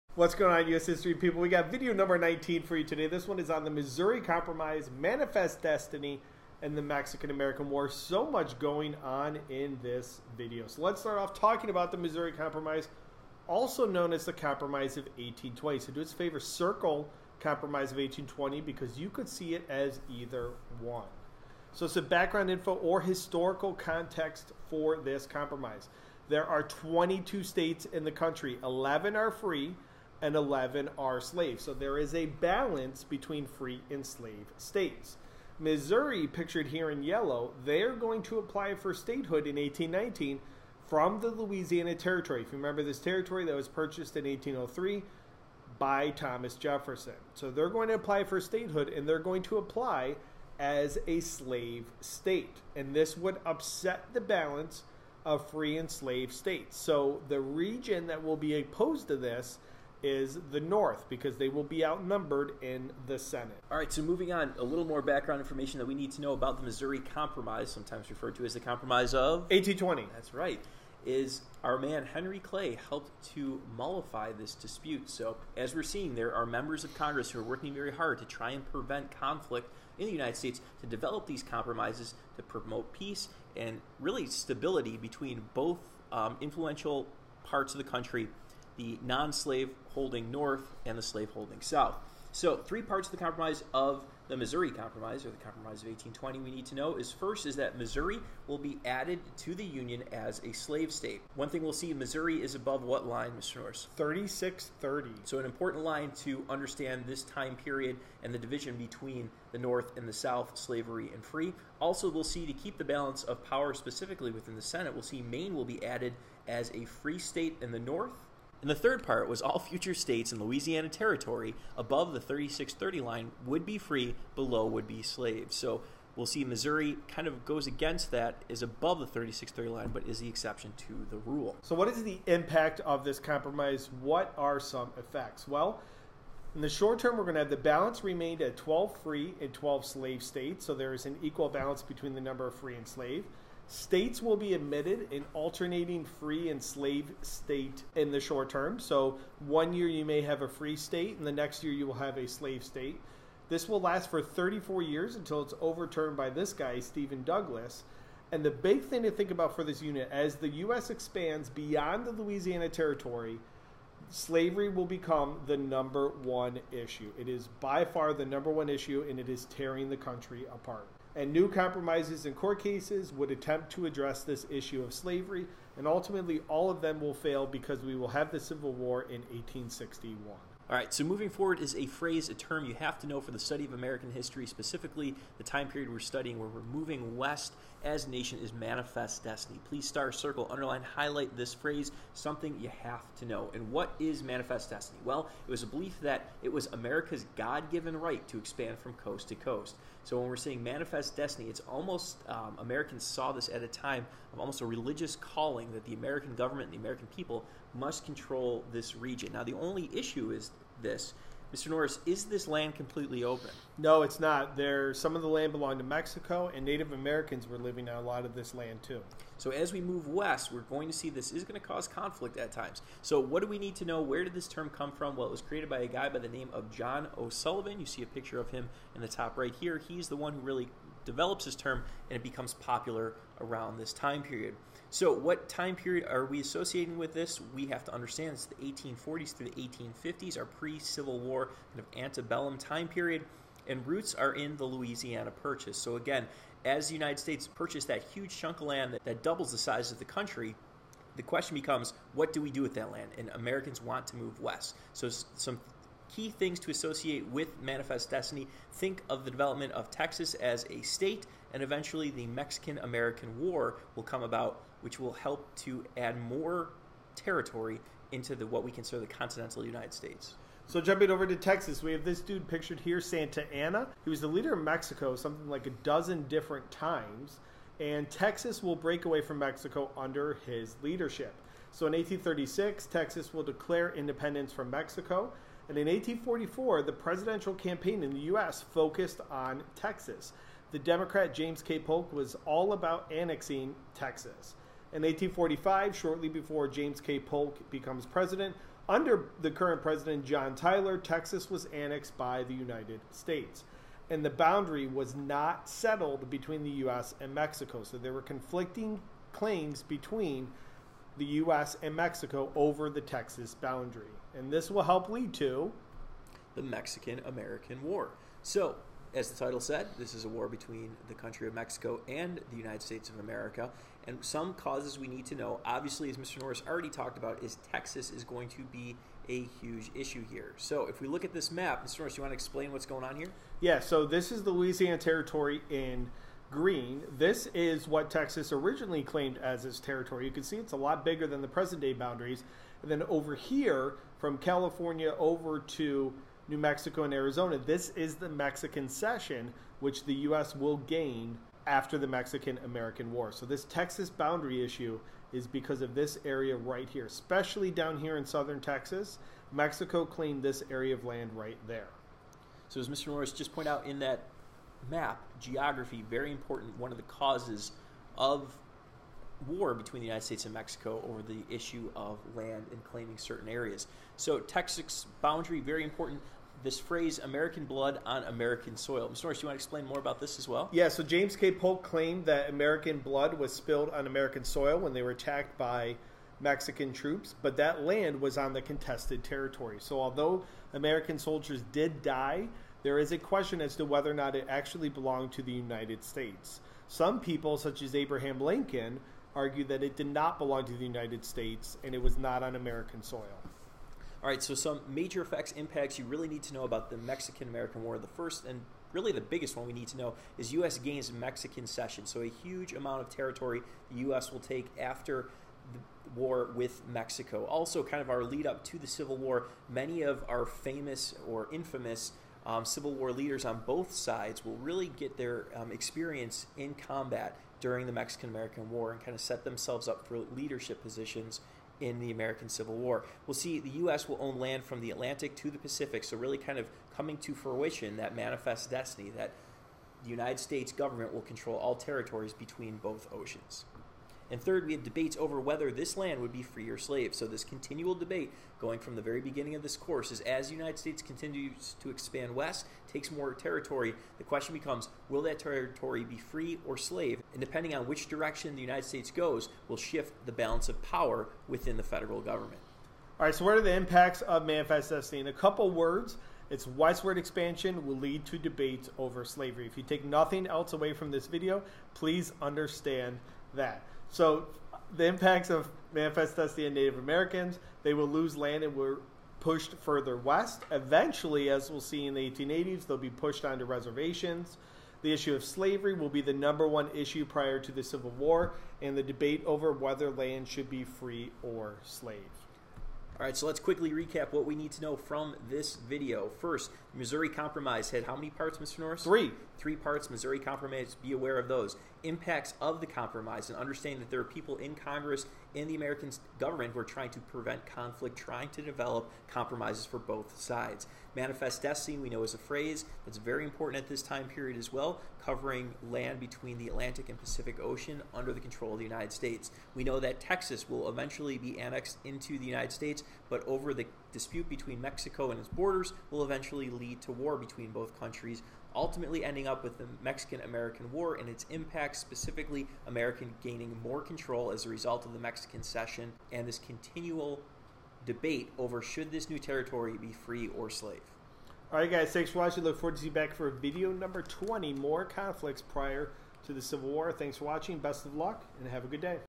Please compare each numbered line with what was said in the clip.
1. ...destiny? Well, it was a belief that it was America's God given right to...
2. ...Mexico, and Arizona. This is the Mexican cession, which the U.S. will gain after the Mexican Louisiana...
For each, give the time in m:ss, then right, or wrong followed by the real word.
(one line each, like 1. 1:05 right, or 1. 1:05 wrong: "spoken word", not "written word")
1. 3:14 right
2. 5:46 wrong: "American", not "Louisiana".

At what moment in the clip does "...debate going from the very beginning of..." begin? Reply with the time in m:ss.
7:27.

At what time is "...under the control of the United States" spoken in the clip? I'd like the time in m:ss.
8:38.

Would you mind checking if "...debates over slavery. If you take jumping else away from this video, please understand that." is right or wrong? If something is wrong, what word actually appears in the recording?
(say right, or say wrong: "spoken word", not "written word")
wrong: "nothing", not "jumping".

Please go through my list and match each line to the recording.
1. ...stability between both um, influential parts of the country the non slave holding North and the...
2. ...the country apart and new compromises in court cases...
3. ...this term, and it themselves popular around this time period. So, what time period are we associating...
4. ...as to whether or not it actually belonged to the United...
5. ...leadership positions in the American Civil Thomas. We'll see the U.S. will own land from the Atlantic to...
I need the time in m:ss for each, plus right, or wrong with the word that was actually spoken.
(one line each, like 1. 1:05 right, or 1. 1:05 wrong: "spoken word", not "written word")
1. 1:24 right
2. 2:49 right
3. 3:51 wrong: "becomes", not "themselves"
4. 6:33 right
5. 7:10 wrong: "War", not "Thomas".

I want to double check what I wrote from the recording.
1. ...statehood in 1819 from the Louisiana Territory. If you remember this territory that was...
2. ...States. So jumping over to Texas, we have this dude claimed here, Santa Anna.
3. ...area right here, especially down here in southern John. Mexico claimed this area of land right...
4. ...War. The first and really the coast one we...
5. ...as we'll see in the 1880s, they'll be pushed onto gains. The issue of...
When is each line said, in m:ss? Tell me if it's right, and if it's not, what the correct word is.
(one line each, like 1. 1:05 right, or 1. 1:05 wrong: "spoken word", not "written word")
1. 0:38 right
2. 4:29 wrong: "pictured", not "claimed"
3. 5:56 wrong: "Texas", not "John"
4. 6:47 wrong: "biggest", not "coast"
5. 8:01 wrong: "reservations", not "gains".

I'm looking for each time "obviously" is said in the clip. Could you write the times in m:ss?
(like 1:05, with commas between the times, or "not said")
5:25.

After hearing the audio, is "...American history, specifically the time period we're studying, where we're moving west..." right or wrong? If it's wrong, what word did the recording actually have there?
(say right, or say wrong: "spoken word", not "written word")
right.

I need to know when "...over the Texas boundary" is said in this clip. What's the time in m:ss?
5:12.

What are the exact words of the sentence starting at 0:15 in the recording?
So do us a favor, circle Compromise of 1820 because you could see it as either one.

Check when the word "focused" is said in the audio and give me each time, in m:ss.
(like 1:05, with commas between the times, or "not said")
4:48.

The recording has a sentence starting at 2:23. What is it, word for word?
States will be admitted in alternating free and slave state in the short term.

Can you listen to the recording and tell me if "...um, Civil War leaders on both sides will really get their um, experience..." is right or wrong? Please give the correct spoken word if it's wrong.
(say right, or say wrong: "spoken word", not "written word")
right.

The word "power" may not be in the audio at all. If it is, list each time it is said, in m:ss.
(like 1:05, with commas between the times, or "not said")
1:53, 7:40.